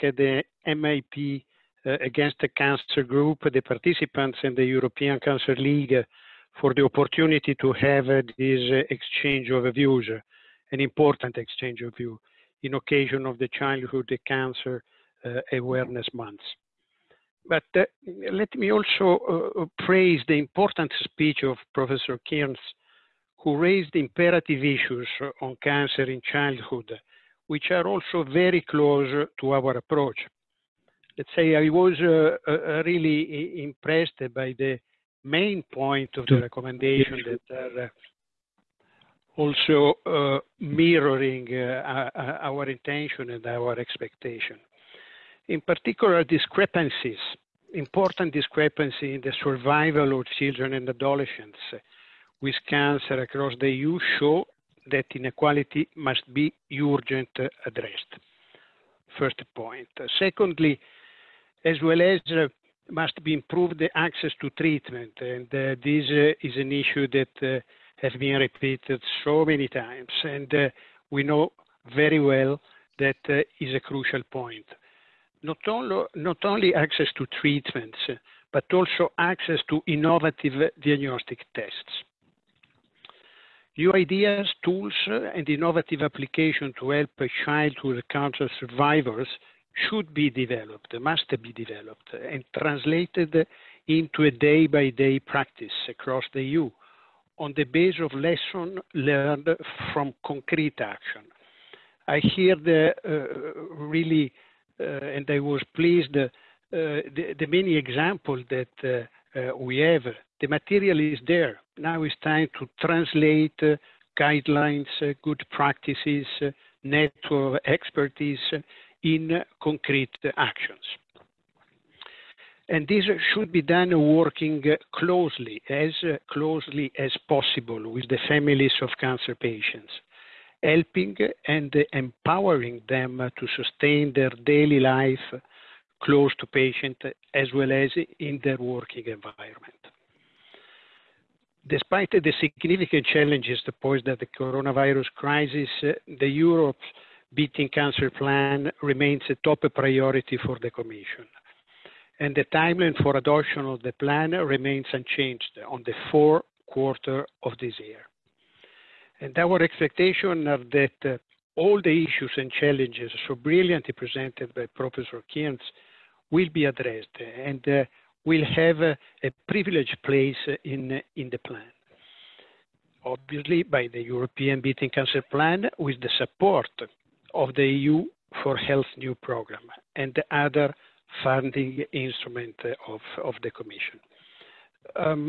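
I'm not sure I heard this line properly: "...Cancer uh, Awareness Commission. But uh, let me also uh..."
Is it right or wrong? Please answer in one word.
wrong.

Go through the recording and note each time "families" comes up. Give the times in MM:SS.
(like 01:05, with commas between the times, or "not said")
02:08.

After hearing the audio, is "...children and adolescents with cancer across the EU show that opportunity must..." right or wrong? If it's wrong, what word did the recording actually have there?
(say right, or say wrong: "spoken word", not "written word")
wrong: "inequality", not "opportunity".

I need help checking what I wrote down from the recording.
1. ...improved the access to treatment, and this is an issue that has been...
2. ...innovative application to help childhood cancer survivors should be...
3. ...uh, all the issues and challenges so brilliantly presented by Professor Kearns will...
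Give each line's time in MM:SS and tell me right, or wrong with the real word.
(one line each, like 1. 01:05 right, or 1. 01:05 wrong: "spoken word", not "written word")
1. 01:03 right
2. 01:25 right
3. 02:41 right.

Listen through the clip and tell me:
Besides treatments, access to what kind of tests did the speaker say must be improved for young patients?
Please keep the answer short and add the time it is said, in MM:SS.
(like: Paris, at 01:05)
innovative diagnostic tests, at 01:19.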